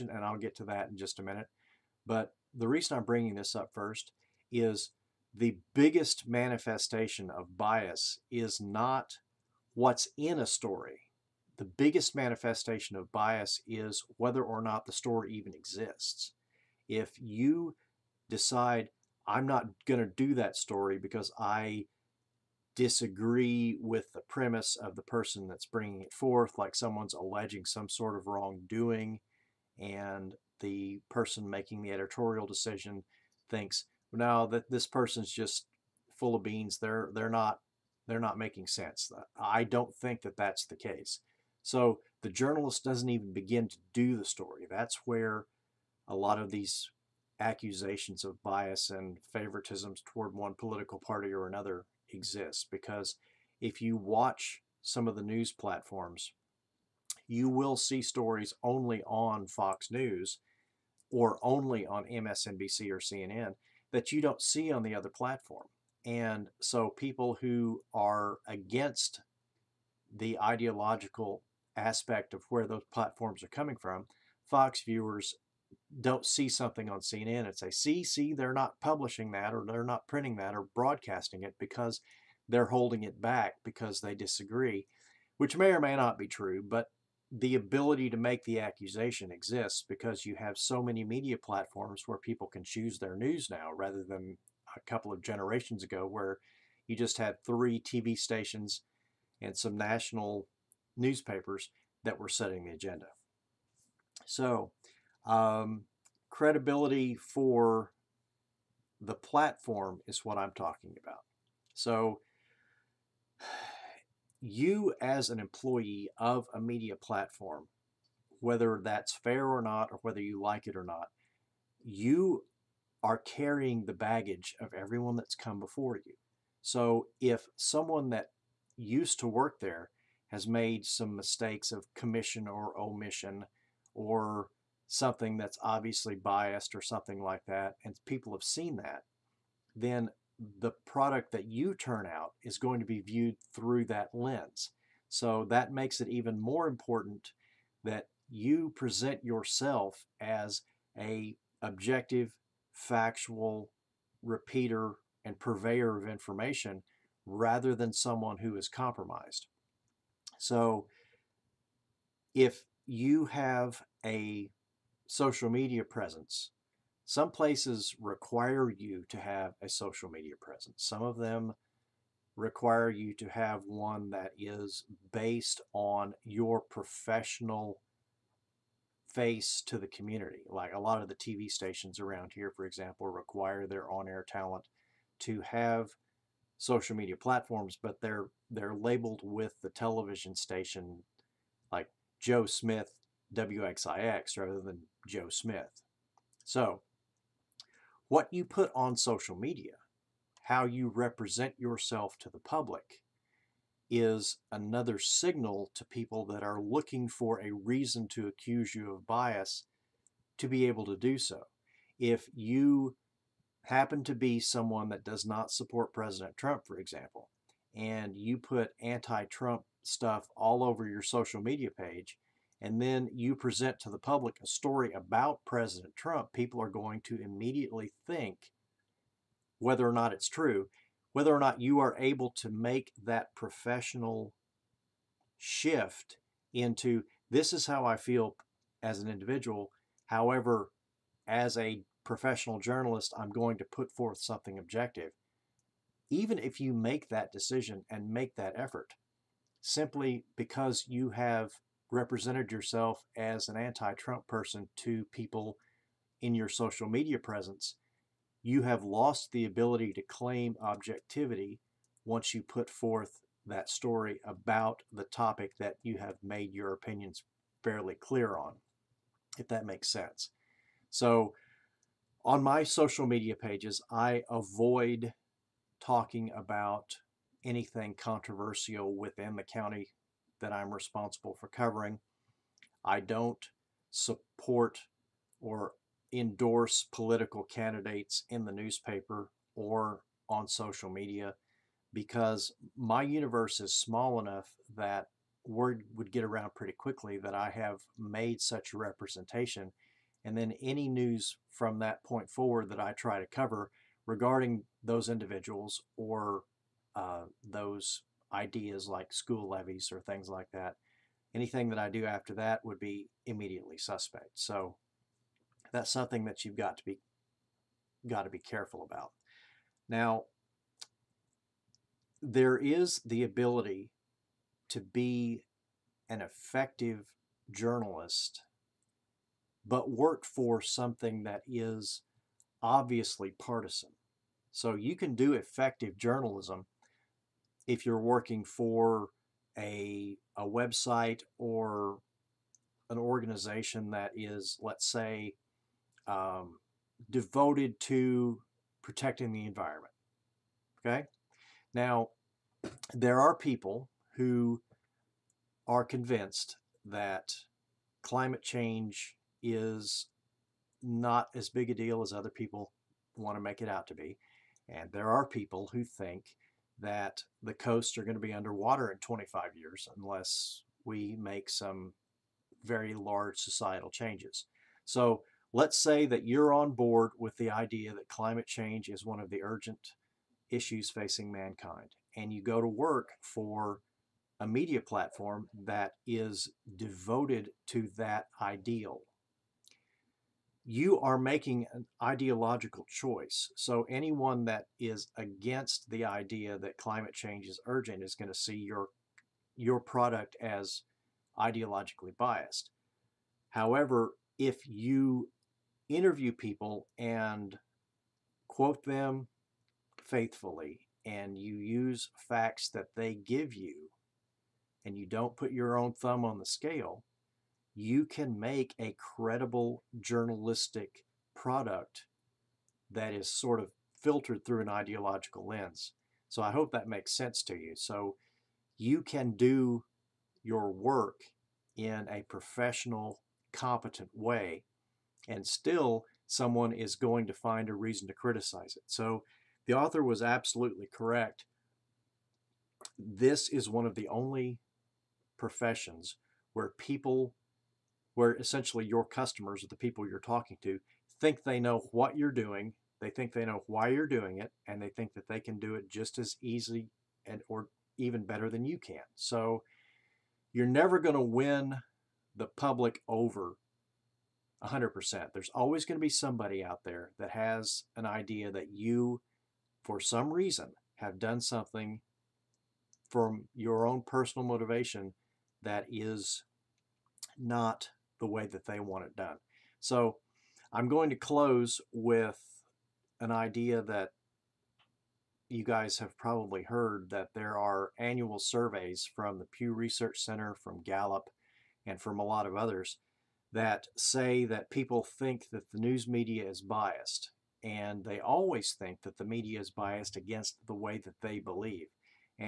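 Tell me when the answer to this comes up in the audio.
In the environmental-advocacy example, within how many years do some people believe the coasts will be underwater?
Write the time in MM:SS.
06:08.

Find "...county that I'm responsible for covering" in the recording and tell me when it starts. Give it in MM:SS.
04:39.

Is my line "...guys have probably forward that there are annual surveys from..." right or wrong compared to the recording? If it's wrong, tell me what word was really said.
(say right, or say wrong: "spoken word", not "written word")
wrong: "heard", not "forward".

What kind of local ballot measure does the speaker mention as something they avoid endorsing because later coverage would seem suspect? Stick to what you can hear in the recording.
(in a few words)
School levies.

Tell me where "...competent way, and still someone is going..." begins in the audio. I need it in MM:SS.
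07:13.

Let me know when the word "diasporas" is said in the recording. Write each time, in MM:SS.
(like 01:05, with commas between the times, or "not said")
not said.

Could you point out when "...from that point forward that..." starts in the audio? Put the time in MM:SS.
05:01.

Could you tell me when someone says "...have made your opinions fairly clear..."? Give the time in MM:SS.
04:25.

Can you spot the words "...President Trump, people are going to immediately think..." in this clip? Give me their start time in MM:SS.
03:45.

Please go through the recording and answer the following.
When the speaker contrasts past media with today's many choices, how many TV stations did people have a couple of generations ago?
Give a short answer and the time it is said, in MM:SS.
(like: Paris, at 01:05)
3, at 01:37.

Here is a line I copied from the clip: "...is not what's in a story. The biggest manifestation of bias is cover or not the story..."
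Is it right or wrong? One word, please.
wrong.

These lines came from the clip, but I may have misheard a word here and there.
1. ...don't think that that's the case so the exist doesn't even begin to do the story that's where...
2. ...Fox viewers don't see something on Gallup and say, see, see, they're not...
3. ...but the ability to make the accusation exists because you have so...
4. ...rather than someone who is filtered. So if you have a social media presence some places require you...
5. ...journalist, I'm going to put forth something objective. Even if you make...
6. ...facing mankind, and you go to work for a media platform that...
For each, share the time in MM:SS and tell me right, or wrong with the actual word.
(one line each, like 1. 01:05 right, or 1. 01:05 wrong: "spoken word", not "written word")
1. 00:39 wrong: "journalist", not "exist"
2. 01:14 wrong: "CNN", not "Gallup"
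3. 01:26 right
4. 02:37 wrong: "compromised", not "filtered"
5. 04:02 right
6. 06:20 right.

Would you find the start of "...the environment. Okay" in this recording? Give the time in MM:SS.
05:49.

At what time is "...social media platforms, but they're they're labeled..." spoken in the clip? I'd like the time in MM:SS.
03:06.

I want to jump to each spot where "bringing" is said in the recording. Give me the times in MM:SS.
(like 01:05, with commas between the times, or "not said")
00:03, 00:25.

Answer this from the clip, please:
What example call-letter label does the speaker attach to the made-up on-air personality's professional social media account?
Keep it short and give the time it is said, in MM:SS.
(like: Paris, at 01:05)
WXIX, at 03:13.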